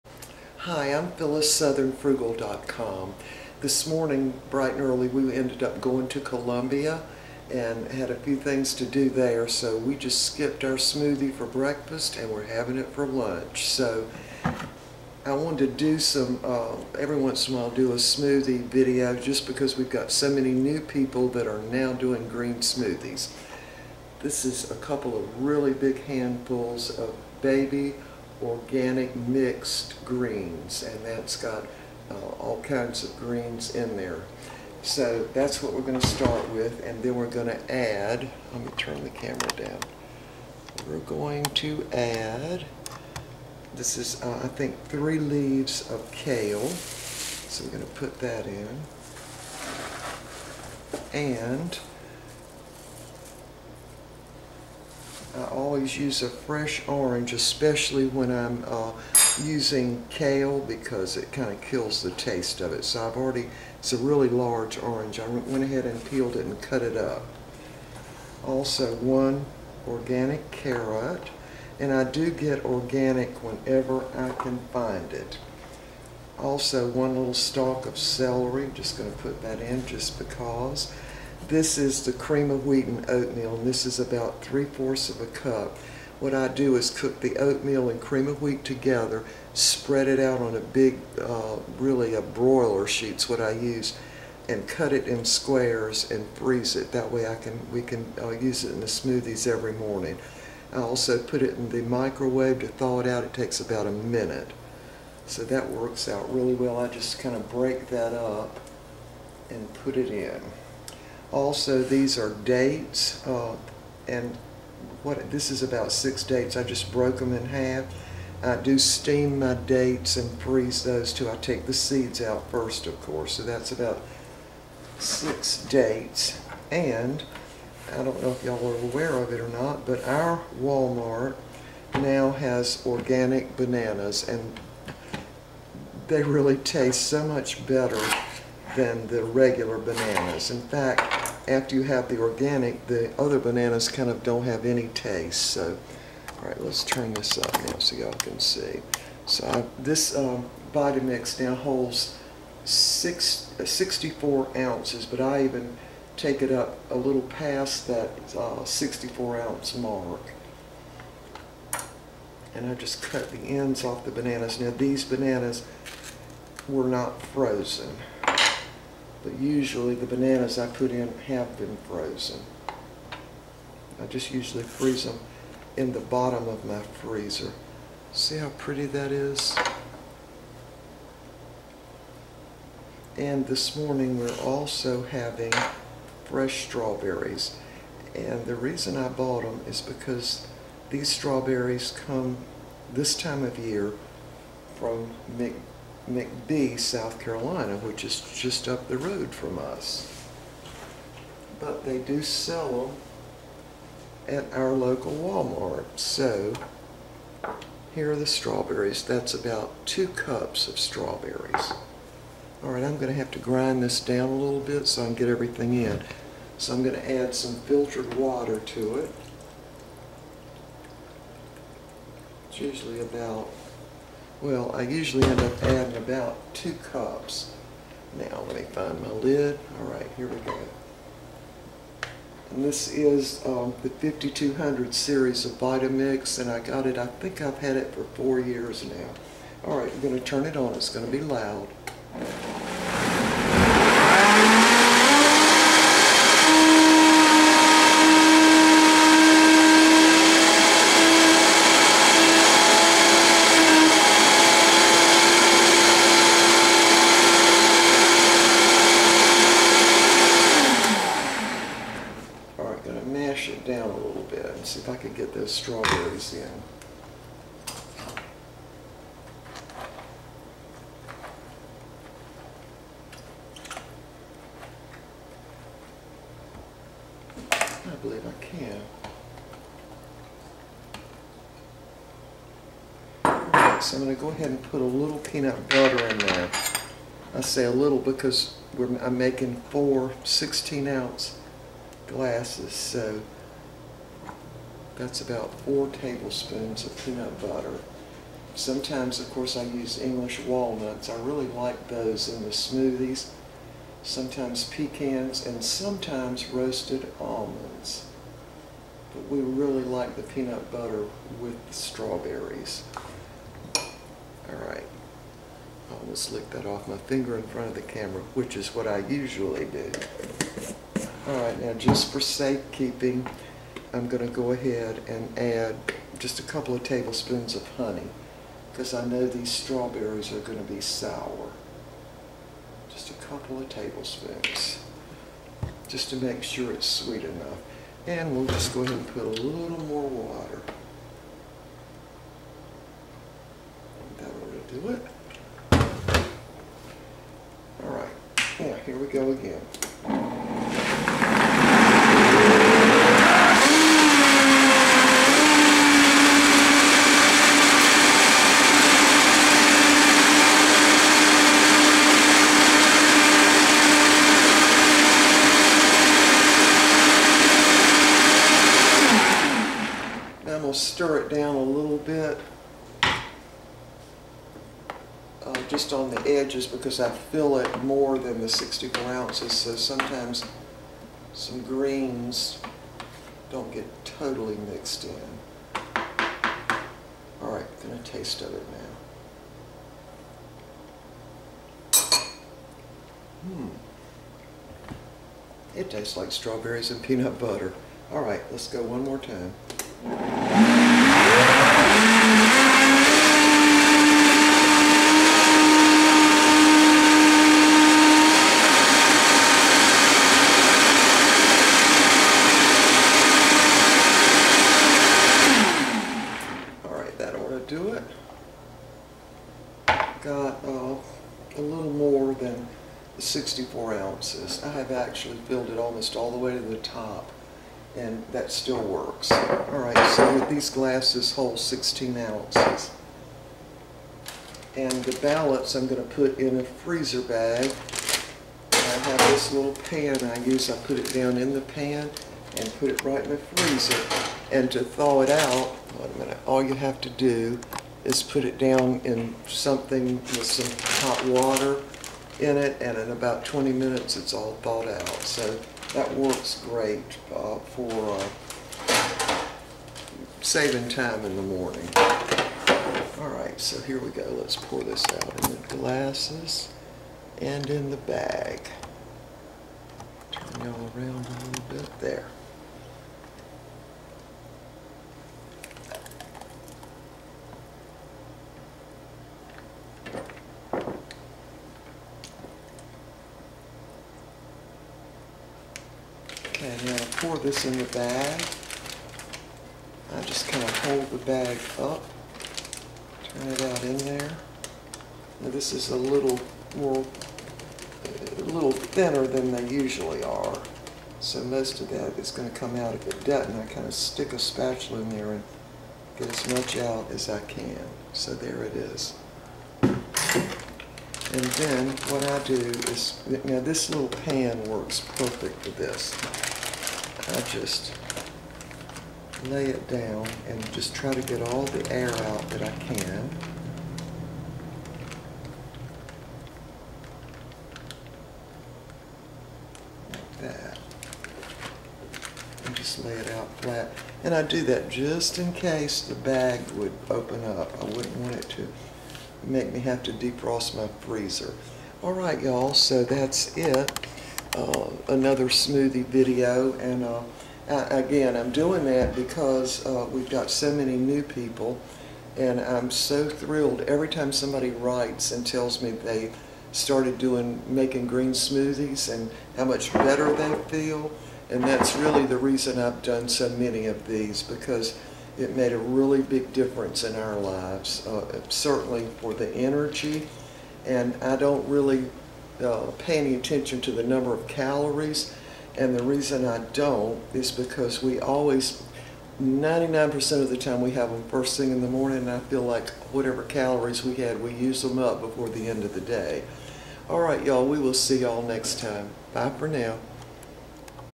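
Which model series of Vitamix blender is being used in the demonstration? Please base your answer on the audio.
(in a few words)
5200.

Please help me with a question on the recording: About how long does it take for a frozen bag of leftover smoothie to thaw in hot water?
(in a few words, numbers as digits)
20 minutes.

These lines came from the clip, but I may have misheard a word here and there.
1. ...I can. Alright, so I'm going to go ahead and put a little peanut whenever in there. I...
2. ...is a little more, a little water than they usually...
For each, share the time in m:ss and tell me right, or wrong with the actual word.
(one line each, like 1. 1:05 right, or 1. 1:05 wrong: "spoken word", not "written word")
1. 4:38 wrong: "butter", not "whenever"
2. 8:15 wrong: "thinner", not "water".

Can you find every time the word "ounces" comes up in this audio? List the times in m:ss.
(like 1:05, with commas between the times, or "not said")
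2:34, 2:39, 4:50, 6:19, 7:03, 7:12.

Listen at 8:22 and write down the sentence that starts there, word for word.
of the does And I kind of stick a spatula in there and get as much out as I can.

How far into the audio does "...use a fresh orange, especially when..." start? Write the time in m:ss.
0:55.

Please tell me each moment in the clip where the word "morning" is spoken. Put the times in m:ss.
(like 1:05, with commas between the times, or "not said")
0:03, 1:39, 3:03, 7:41, 9:41.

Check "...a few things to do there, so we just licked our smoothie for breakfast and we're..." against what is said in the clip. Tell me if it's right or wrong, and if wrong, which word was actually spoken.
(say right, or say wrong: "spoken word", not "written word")
wrong: "skipped", not "licked".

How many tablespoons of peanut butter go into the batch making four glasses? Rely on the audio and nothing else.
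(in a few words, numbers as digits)
4.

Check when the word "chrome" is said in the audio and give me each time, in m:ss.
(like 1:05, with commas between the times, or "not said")
not said.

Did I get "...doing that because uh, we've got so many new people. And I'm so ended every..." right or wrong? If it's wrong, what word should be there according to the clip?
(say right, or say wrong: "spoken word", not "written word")
wrong: "thrilled", not "ended".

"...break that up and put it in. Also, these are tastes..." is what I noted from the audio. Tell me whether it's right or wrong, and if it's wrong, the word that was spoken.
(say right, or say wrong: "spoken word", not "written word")
wrong: "dates", not "tastes".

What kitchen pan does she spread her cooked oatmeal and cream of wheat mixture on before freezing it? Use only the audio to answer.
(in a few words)
Broiler sheet.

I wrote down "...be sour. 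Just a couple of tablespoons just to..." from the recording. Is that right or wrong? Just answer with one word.
right.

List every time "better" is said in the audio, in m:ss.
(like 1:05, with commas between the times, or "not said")
2:17, 9:19.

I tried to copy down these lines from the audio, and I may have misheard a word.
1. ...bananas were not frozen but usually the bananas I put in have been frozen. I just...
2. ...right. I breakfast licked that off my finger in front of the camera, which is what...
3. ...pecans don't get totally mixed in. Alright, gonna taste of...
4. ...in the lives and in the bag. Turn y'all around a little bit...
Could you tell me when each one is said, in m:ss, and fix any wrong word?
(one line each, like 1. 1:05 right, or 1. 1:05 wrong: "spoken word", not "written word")
1. 2:45 right
2. 5:14 wrong: "almost", not "breakfast"
3. 6:21 wrong: "greens", not "pecans"
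4. 7:45 wrong: "glasses", not "lives".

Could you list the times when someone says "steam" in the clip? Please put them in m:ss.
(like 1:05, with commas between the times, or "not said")
1:58.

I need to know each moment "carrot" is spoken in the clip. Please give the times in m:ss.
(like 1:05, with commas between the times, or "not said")
1:10.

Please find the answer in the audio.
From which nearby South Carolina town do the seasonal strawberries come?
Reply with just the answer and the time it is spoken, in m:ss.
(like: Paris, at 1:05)
McBee, at 3:16.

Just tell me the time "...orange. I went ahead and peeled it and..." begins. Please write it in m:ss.
1:04.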